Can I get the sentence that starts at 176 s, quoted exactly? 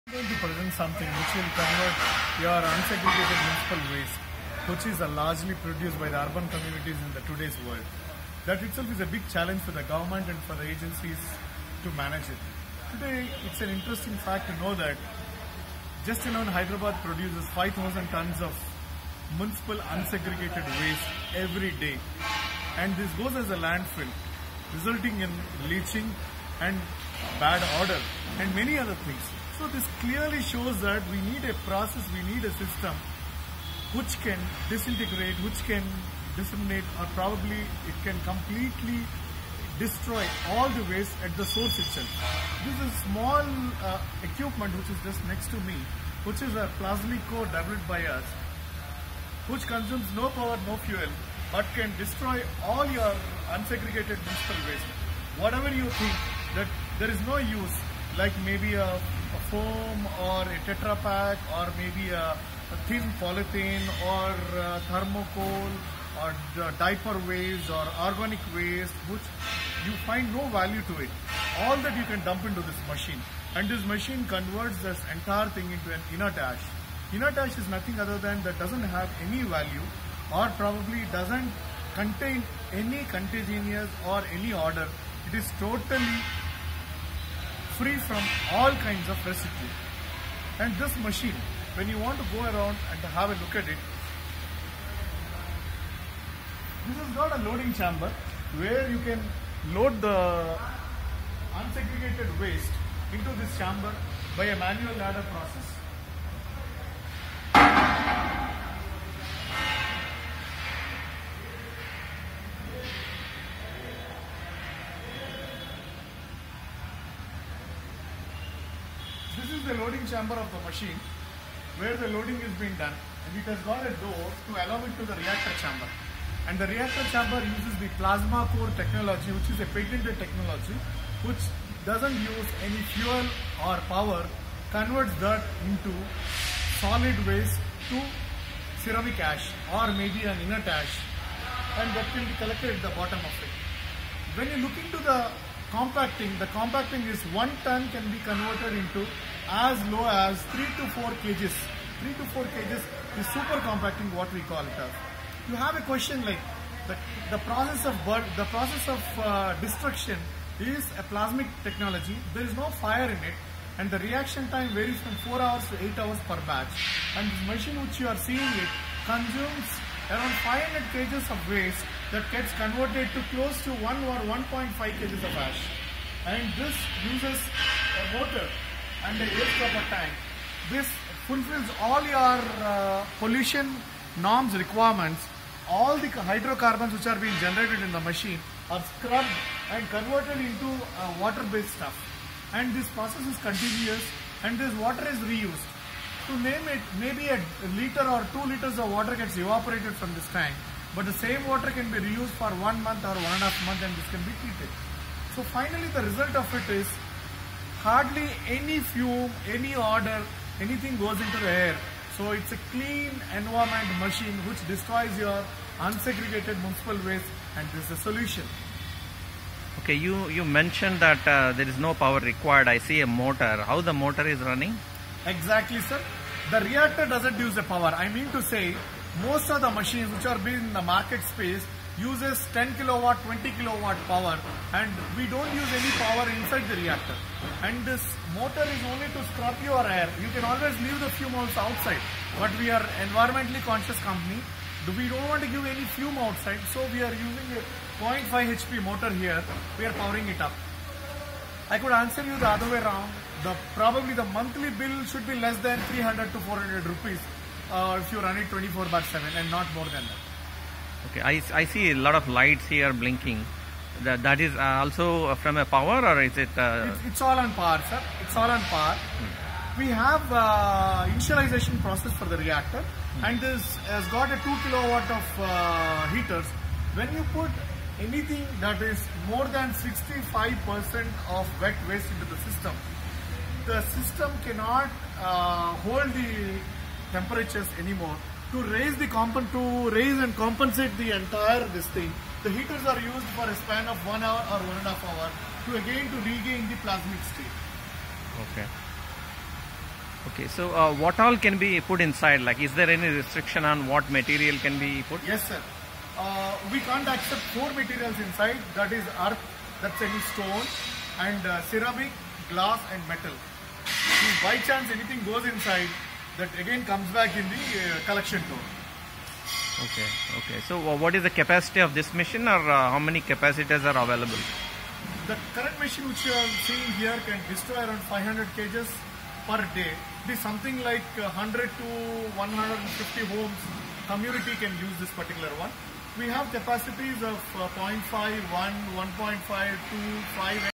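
And this uses uh, water and the air stopper tank.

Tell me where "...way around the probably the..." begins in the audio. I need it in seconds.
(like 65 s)
252 s.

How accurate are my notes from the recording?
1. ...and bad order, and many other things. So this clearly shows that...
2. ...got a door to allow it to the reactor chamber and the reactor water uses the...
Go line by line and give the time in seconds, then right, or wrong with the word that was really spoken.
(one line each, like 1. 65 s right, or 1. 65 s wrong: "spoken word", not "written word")
1. 26 s right
2. 123 s wrong: "chamber", not "water".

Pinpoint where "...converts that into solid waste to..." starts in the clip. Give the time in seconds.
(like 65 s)
134 s.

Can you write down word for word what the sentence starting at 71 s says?
All that you can dump into this machine and this machine converts this entire thing into an inert ash.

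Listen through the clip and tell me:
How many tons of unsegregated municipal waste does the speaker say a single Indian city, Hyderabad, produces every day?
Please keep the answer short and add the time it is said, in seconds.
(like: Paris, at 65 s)
5,000 tons, at 17 s.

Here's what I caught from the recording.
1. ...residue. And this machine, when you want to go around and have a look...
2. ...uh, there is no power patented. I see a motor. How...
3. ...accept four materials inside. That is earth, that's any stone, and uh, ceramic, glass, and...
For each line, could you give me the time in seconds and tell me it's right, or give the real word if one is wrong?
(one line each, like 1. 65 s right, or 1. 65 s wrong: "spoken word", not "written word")
1. 89 s right
2. 221 s wrong: "required", not "patented"
3. 307 s right.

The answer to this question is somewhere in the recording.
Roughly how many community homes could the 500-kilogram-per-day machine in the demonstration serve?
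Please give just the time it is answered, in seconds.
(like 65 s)
331 s.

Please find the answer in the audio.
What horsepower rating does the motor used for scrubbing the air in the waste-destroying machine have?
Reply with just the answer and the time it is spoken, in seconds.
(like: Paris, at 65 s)
0.5 HP, at 248 s.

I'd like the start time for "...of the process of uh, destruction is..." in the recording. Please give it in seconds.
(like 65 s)
157 s.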